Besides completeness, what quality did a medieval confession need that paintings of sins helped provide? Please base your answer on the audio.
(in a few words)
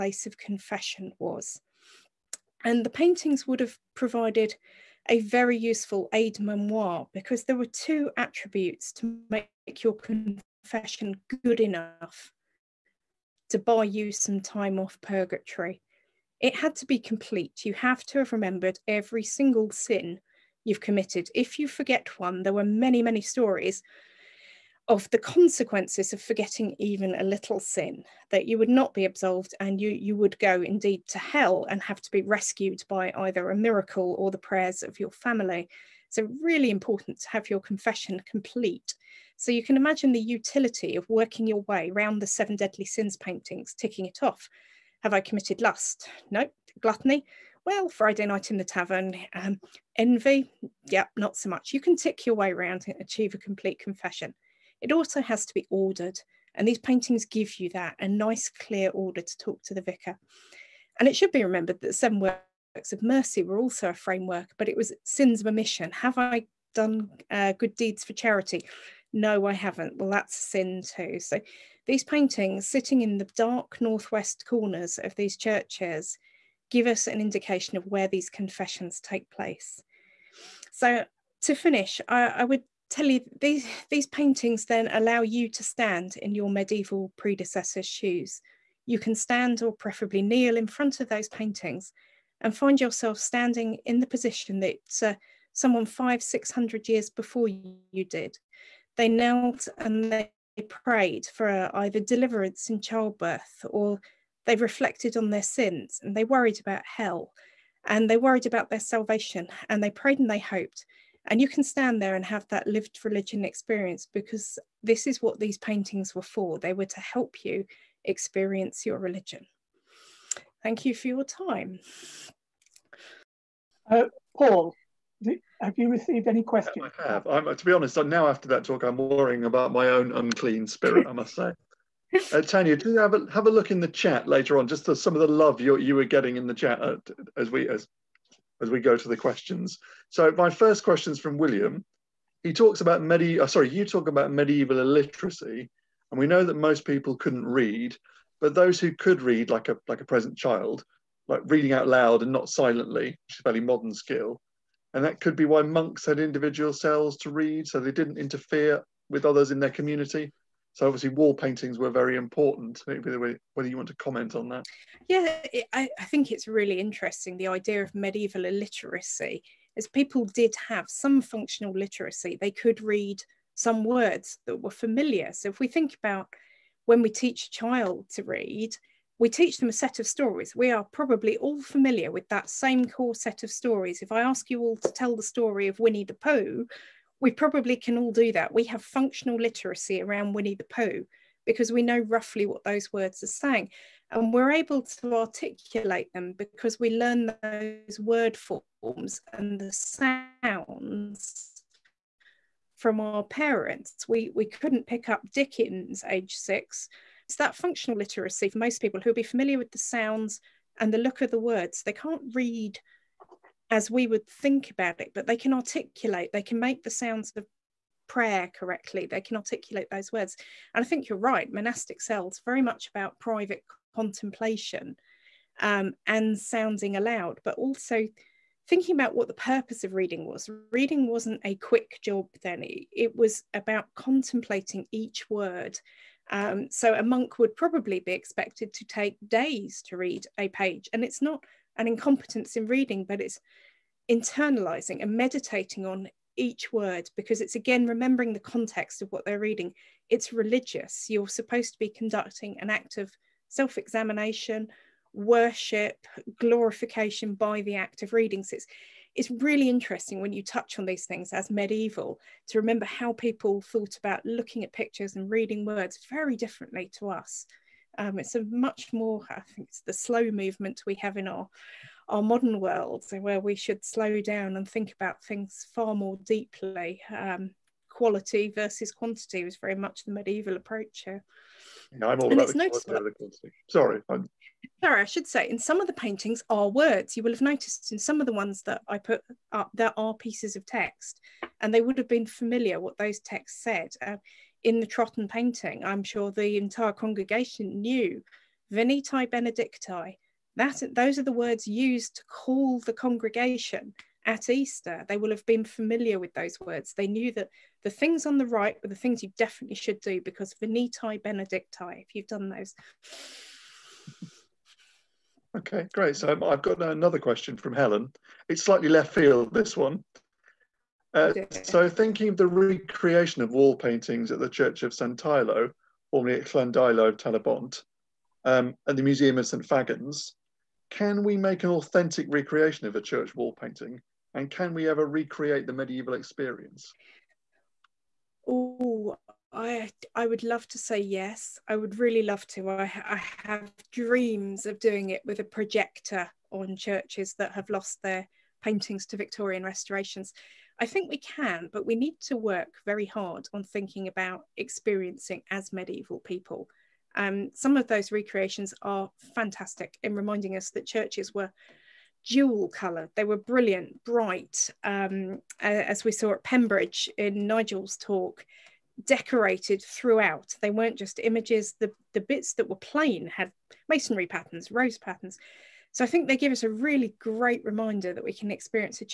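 Ordered.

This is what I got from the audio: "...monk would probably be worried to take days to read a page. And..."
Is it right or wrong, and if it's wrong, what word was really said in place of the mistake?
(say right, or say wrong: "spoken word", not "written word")
wrong: "expected", not "worried".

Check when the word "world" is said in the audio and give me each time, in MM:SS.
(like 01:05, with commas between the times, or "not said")
04:32.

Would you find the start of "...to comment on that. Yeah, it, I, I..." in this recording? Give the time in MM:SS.
02:43.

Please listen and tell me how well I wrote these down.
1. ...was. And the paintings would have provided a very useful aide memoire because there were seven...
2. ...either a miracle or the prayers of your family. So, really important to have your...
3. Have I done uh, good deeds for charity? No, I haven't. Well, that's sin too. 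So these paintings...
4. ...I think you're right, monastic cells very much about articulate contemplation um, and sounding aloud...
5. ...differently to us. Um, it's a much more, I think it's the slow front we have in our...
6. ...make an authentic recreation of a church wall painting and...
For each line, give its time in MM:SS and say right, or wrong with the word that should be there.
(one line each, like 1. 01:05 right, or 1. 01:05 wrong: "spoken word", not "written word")
1. 00:01 wrong: "two", not "seven"
2. 00:33 right
3. 01:05 right
4. 03:40 wrong: "private", not "articulate"
5. 04:26 wrong: "movement", not "front"
6. 05:31 right.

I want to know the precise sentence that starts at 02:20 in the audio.
So my first question is from William.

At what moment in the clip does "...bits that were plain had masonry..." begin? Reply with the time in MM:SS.
06:12.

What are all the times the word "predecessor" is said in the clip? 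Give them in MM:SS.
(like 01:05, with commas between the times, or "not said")
01:27.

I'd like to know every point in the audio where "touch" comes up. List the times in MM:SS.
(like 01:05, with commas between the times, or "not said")
04:20.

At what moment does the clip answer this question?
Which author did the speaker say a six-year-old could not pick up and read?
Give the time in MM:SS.
03:25.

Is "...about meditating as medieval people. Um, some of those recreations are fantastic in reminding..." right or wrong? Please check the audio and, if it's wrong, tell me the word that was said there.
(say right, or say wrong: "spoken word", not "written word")
wrong: "experiencing", not "meditating".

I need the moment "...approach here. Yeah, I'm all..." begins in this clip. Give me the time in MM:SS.
04:40.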